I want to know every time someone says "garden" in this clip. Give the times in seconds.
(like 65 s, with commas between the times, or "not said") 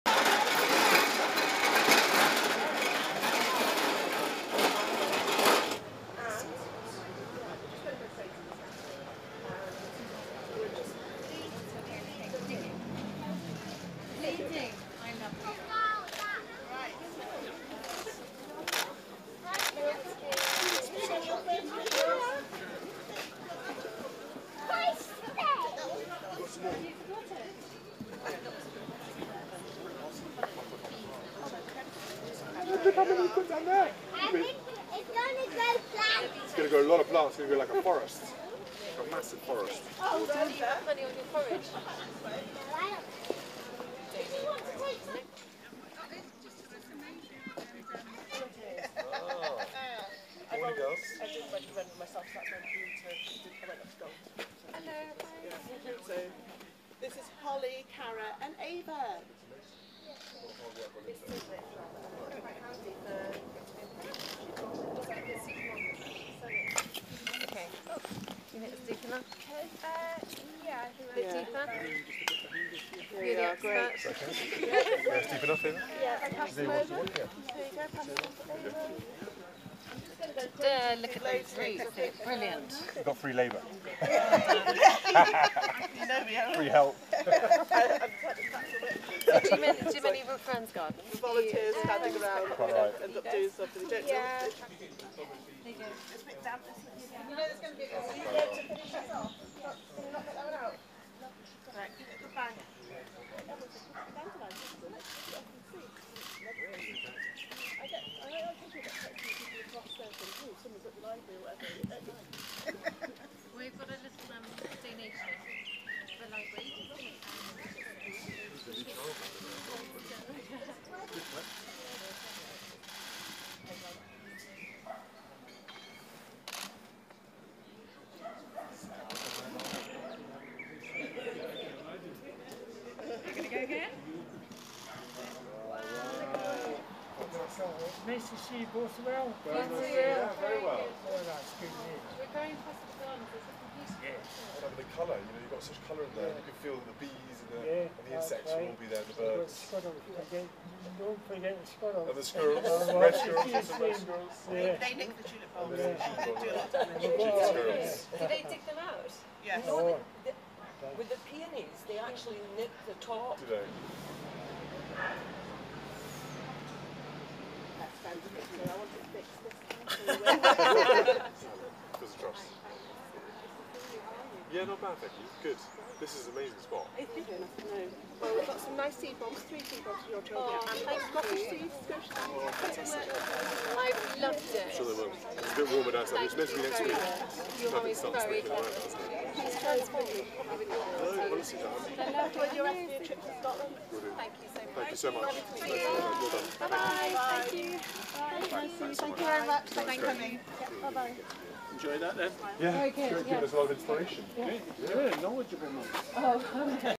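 90 s, 142 s.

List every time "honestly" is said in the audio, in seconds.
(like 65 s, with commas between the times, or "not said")
191 s.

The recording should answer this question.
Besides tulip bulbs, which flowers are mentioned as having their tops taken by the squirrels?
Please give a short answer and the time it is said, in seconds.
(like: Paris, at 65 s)
Peonies, at 161 s.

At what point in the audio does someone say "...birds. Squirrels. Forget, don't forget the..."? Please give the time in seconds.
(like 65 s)
149 s.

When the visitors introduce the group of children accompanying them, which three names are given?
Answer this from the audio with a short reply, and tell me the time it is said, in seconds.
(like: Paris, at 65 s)
Holly, Cara, and Ava, at 57 s.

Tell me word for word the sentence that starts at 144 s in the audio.
And the colour, you know, you've got such colour in there.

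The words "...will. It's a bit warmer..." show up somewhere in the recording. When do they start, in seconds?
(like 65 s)
185 s.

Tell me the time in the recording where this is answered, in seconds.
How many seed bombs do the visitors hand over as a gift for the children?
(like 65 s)
179 s.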